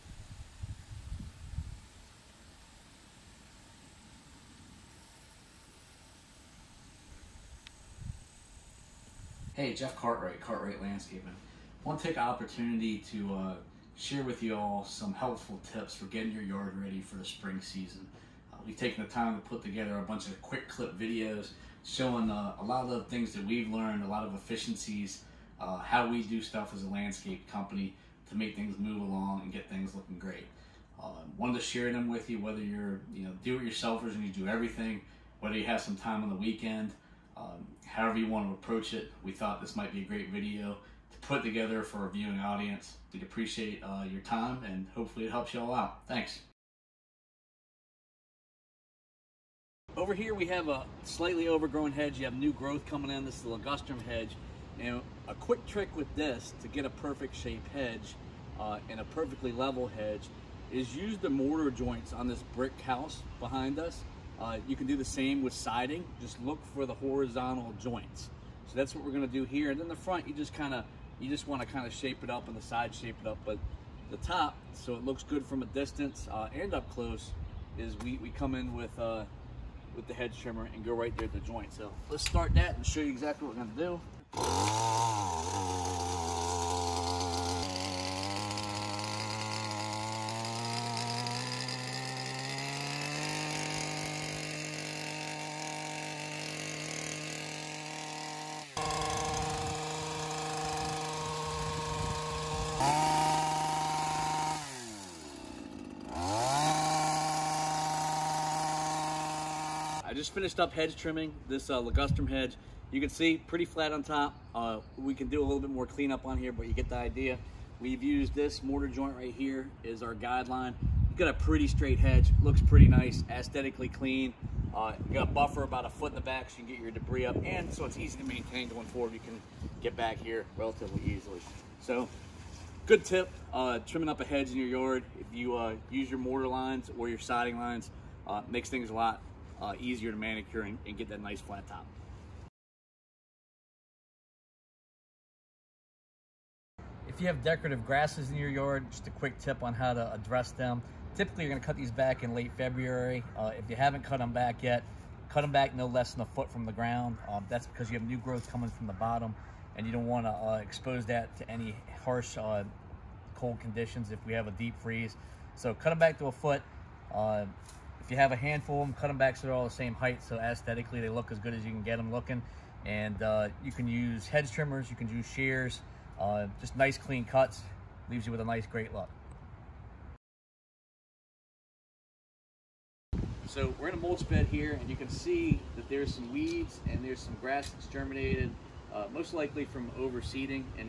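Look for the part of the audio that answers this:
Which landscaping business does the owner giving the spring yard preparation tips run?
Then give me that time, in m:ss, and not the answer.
0:10.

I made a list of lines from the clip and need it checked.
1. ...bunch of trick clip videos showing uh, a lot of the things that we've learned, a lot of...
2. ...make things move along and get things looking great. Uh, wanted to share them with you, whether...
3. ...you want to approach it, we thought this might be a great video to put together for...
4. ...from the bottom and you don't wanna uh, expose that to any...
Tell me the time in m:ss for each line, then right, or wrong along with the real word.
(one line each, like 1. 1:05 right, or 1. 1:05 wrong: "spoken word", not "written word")
1. 0:20 wrong: "quick", not "trick"
2. 0:28 right
3. 0:38 right
4. 2:38 right.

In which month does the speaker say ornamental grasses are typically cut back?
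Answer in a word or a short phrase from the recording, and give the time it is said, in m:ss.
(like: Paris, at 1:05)
Late February, at 2:32.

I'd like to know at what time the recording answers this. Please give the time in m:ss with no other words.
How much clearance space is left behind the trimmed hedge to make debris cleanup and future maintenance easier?
2:05.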